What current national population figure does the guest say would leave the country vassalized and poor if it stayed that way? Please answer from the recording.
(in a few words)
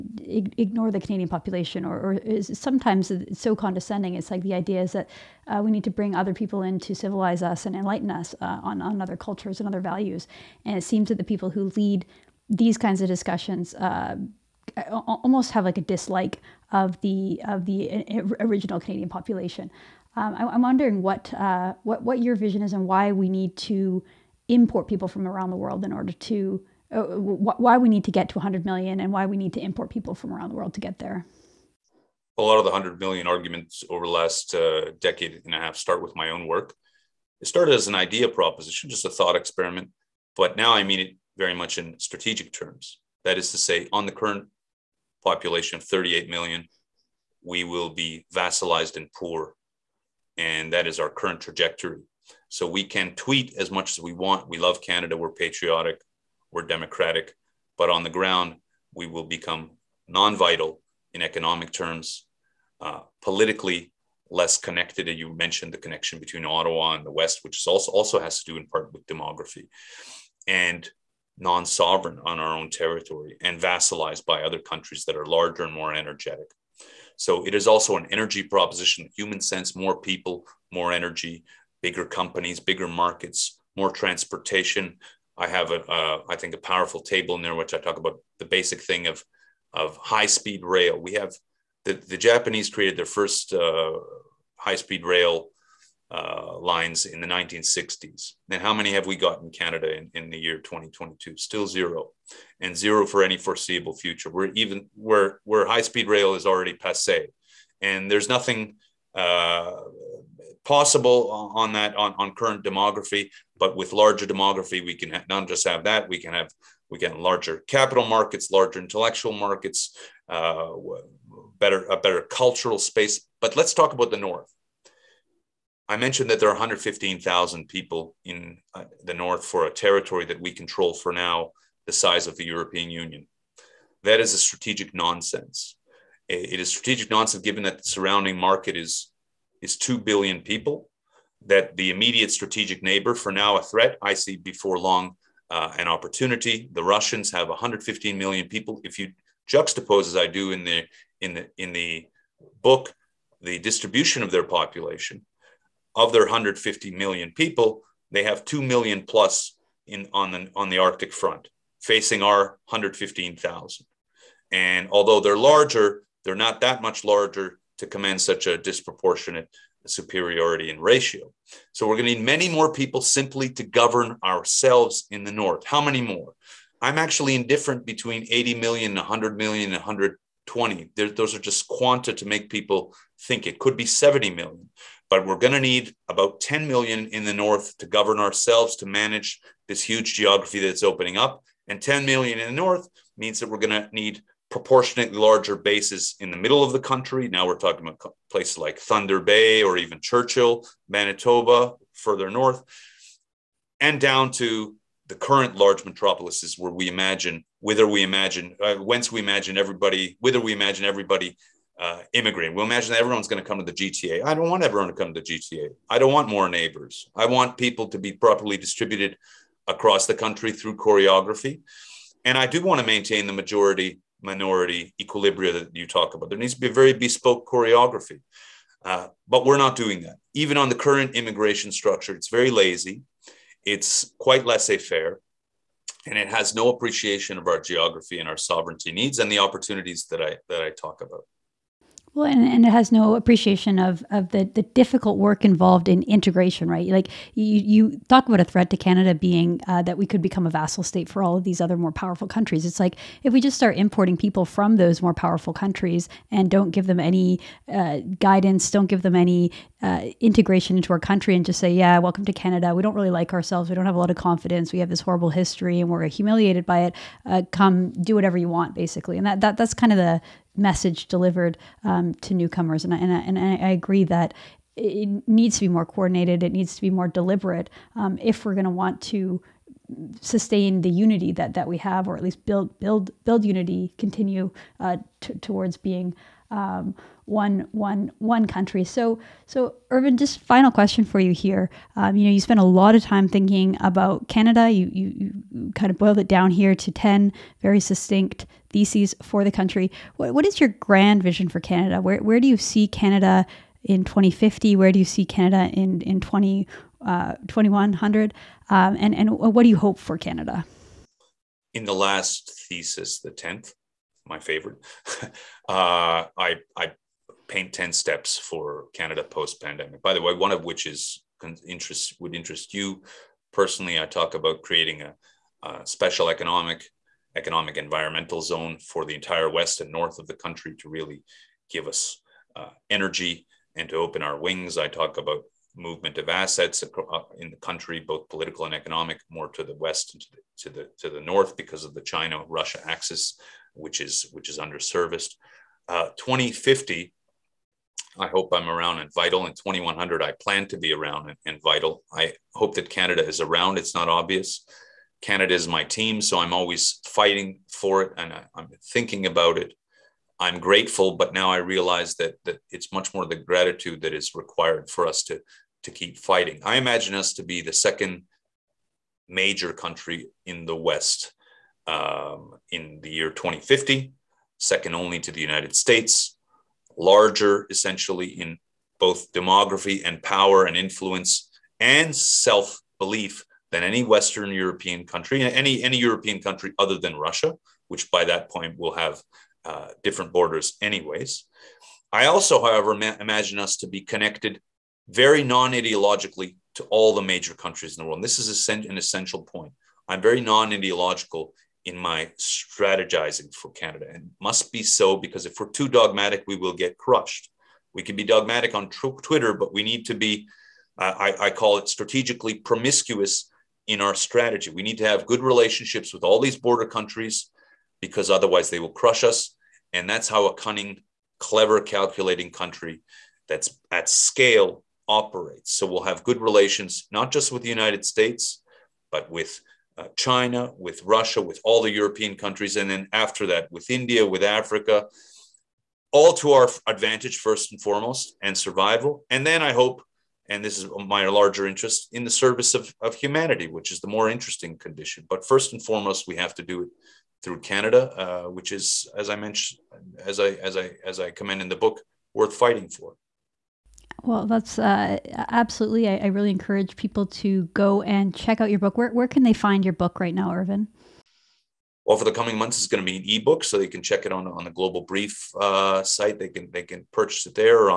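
38 million.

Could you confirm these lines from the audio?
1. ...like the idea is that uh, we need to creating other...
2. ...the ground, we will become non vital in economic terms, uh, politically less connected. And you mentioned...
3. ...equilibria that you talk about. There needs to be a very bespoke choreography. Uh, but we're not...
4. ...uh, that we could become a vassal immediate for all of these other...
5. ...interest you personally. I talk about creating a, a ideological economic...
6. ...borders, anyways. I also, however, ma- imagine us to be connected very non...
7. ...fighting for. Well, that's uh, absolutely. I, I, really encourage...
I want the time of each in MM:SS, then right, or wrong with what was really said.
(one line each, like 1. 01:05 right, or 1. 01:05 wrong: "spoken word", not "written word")
1. 00:04 wrong: "bring", not "creating"
2. 00:58 right
3. 03:45 right
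4. 04:09 wrong: "state", not "immediate"
5. 05:22 wrong: "special", not "ideological"
6. 06:30 right
7. 07:32 right.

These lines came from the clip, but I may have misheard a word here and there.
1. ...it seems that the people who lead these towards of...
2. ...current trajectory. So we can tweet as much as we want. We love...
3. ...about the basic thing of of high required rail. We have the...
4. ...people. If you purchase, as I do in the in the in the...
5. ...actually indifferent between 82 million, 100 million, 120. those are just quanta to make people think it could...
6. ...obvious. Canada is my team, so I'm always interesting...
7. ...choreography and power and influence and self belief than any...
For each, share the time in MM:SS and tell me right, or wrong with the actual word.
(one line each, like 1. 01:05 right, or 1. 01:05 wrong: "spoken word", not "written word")
1. 00:10 wrong: "kinds", not "towards"
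2. 00:51 right
3. 01:27 wrong: "speed", not "required"
4. 02:28 wrong: "juxtapose", not "purchase"
5. 02:56 wrong: "80", not "82"
6. 05:54 wrong: "fighting", not "interesting"
7. 06:19 wrong: "demography", not "choreography".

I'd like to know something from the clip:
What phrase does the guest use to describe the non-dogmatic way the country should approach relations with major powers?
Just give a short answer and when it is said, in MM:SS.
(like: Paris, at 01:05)
strategically promiscuous, at 06:51.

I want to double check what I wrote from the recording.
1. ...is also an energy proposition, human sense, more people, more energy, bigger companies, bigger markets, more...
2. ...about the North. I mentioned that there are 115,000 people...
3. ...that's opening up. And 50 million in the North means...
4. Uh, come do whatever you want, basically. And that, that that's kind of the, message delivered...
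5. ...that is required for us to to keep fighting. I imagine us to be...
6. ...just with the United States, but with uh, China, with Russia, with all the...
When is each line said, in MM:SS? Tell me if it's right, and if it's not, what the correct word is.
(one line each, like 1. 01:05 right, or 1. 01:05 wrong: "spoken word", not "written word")
1. 01:17 right
2. 02:03 right
3. 03:10 wrong: "10", not "50"
4. 04:27 right
5. 06:04 right
6. 07:07 right.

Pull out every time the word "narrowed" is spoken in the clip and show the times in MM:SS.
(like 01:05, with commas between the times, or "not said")
not said.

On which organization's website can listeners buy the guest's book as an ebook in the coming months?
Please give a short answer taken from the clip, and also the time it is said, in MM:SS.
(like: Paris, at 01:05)
Global Brief, at 07:44.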